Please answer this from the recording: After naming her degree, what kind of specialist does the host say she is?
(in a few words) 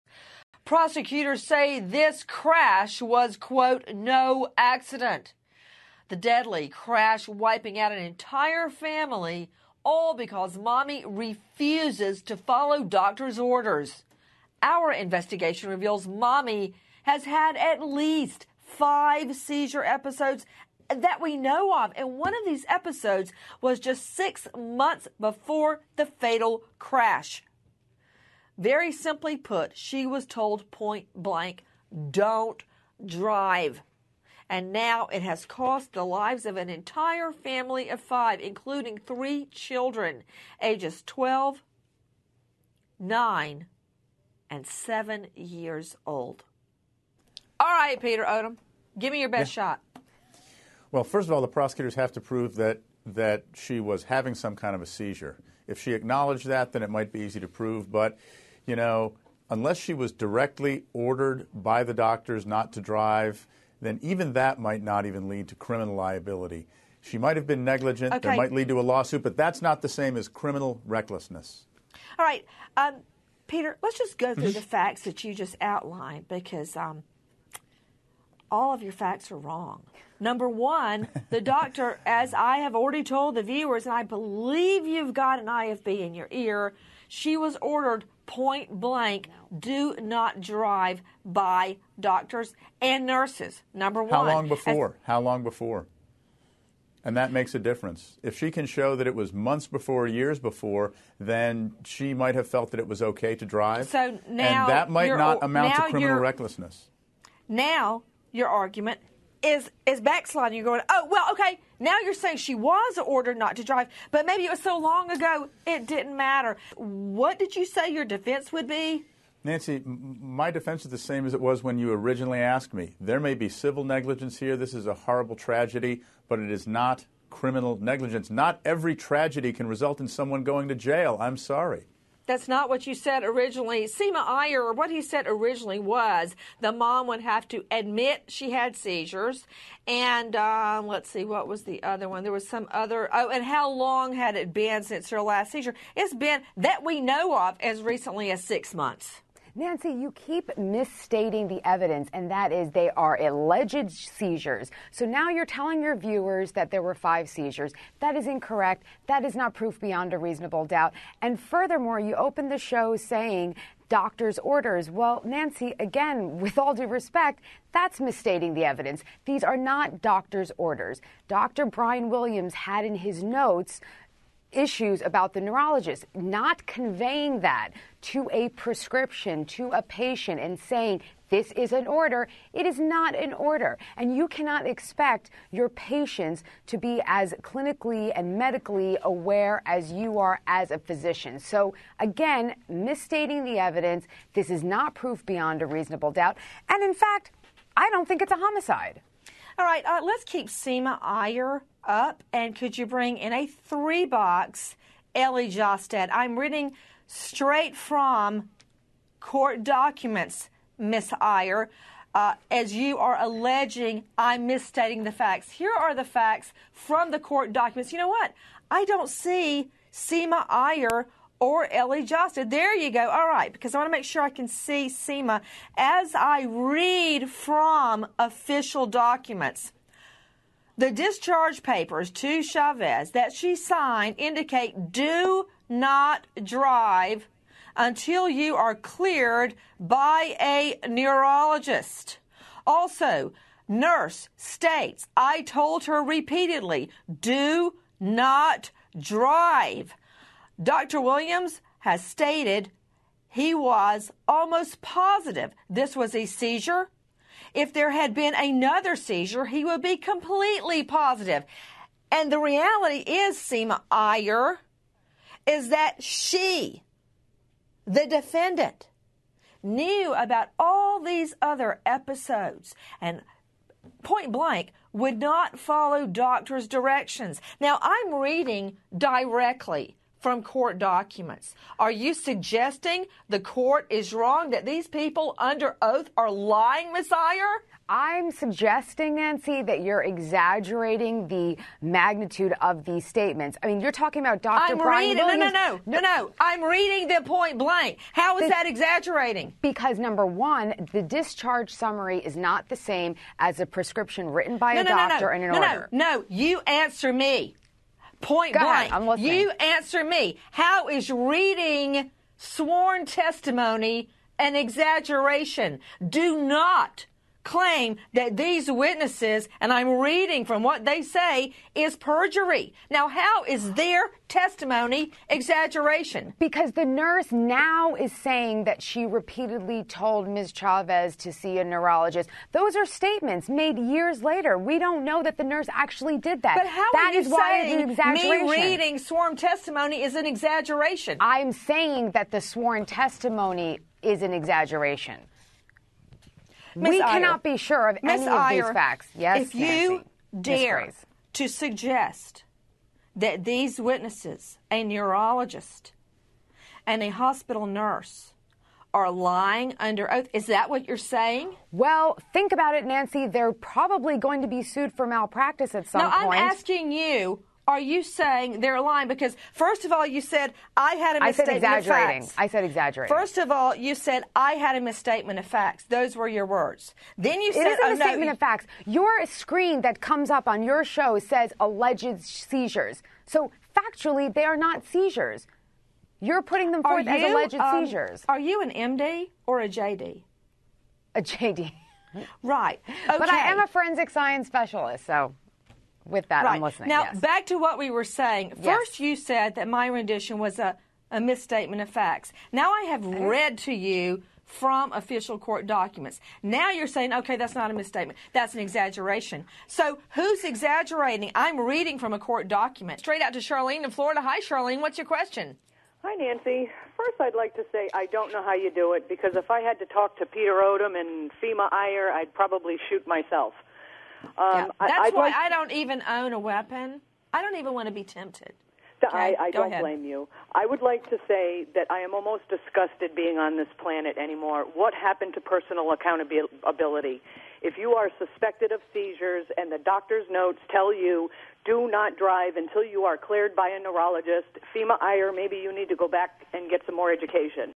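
forensic science specialist.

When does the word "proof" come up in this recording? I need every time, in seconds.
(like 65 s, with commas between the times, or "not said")
159 s, 194 s.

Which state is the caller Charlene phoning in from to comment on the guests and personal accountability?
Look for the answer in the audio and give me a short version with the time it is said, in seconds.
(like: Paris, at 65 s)
Florida, at 413 s.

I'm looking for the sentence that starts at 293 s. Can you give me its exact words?
I mean, you're talking about Dr.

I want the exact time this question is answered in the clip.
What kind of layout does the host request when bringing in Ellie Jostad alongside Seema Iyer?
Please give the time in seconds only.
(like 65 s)
203 s.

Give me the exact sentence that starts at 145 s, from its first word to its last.
It's been that we know of as recently as six months.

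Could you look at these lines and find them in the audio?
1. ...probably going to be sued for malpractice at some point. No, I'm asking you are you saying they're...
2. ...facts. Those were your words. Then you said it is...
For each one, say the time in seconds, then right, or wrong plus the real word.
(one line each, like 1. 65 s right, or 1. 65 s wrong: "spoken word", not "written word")
1. 363 s right
2. 375 s right.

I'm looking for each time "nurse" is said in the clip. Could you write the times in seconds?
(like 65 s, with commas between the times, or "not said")
93 s, 243 s, 326 s, 335 s, 357 s.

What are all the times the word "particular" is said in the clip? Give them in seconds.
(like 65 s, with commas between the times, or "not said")
not said.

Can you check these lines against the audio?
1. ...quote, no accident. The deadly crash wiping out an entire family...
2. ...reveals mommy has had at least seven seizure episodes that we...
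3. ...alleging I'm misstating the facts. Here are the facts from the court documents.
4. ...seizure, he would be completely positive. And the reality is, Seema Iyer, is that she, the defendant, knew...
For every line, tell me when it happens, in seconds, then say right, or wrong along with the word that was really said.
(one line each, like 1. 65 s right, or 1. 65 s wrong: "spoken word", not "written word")
1. 3 s right
2. 15 s wrong: "five", not "seven"
3. 213 s right
4. 258 s right.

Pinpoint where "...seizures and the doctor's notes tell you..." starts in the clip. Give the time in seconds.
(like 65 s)
438 s.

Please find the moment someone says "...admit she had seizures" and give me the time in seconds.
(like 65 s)
137 s.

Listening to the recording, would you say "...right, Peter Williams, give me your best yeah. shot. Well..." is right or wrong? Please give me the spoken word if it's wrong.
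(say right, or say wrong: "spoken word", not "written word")
wrong: "Odom", not "Williams".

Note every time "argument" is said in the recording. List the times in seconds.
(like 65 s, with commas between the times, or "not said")
108 s.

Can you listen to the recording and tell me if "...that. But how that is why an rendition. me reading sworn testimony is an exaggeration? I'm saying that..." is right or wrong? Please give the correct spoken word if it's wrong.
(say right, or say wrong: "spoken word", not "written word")
wrong: "exaggeration", not "rendition".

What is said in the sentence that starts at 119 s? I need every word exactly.
Nancy, my defense is the same as it was when you originally asked me.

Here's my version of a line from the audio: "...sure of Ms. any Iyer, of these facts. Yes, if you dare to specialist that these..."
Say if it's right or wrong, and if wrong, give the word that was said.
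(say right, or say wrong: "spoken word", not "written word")
wrong: "suggest", not "specialist".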